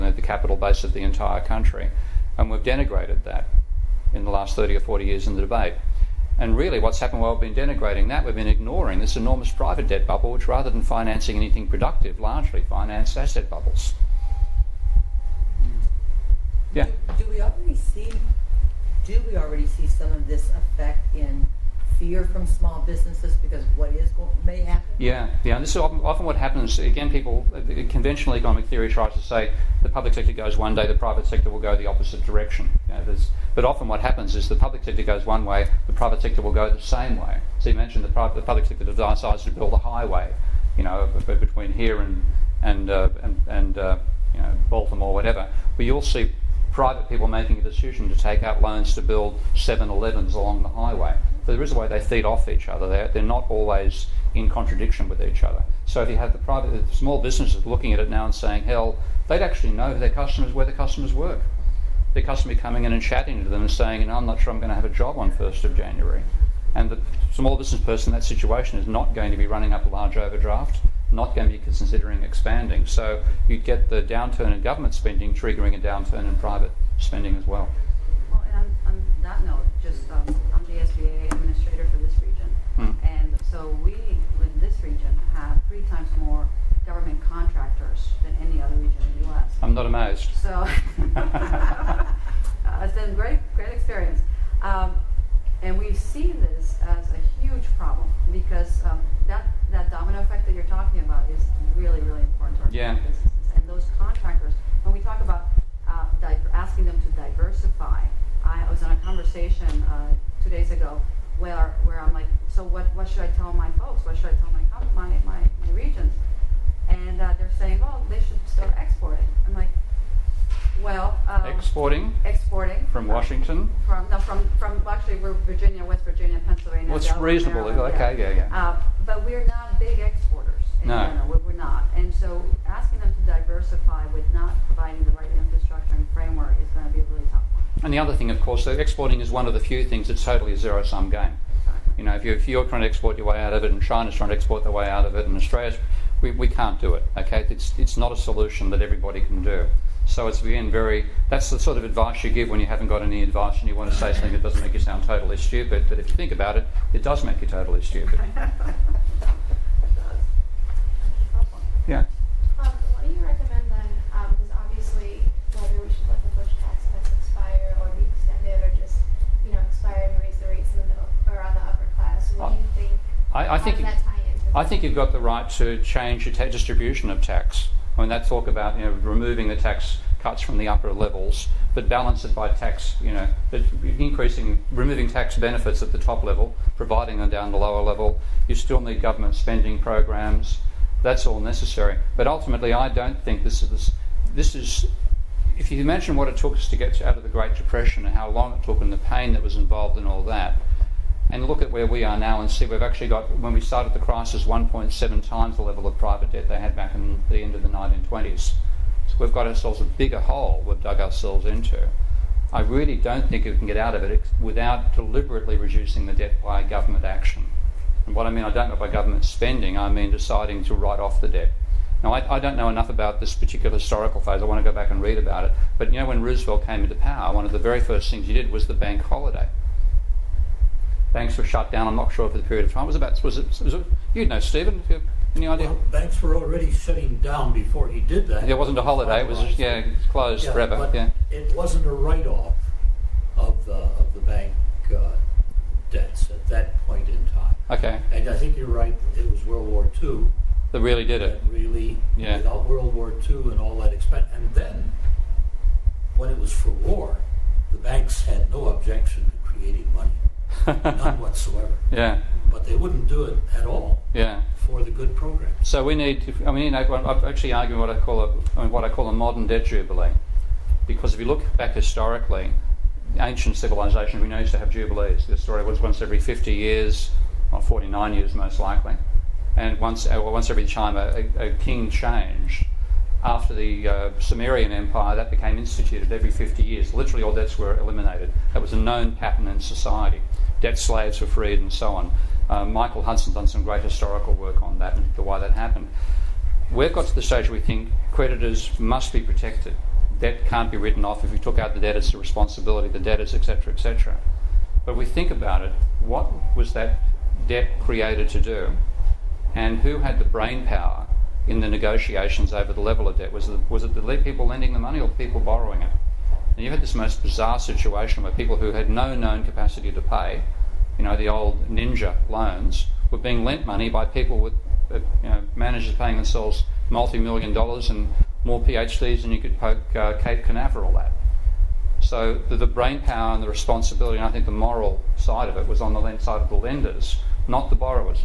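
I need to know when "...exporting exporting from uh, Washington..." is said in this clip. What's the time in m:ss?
2:01.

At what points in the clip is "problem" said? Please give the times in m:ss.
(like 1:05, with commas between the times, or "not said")
1:37.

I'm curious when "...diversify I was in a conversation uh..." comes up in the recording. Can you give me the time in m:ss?
1:47.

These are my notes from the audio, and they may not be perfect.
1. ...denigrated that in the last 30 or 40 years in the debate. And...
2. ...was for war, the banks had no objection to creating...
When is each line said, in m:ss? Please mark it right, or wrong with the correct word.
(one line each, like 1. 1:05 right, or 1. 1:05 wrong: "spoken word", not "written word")
1. 0:02 right
2. 4:16 right.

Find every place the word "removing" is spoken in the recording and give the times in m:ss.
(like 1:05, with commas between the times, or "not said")
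2:58, 3:04.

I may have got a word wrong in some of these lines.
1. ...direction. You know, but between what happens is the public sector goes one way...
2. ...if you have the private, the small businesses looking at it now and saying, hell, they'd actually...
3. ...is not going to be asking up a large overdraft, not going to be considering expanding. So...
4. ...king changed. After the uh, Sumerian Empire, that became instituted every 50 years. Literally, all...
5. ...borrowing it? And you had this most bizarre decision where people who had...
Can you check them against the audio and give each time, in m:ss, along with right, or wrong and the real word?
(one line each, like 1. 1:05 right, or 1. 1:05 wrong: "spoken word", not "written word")
1. 0:32 wrong: "often", not "between"
2. 0:56 right
3. 1:08 wrong: "running", not "asking"
4. 4:41 right
5. 5:15 wrong: "situation", not "decision".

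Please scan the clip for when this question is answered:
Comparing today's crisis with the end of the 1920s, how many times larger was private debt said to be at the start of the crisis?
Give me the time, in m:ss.
3:24.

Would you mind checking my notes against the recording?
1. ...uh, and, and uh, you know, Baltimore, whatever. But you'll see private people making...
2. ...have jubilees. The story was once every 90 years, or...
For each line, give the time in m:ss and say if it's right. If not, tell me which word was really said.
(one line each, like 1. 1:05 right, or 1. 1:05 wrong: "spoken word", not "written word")
1. 0:42 right
2. 4:34 wrong: "50", not "90".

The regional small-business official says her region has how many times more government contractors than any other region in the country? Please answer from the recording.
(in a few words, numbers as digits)
3.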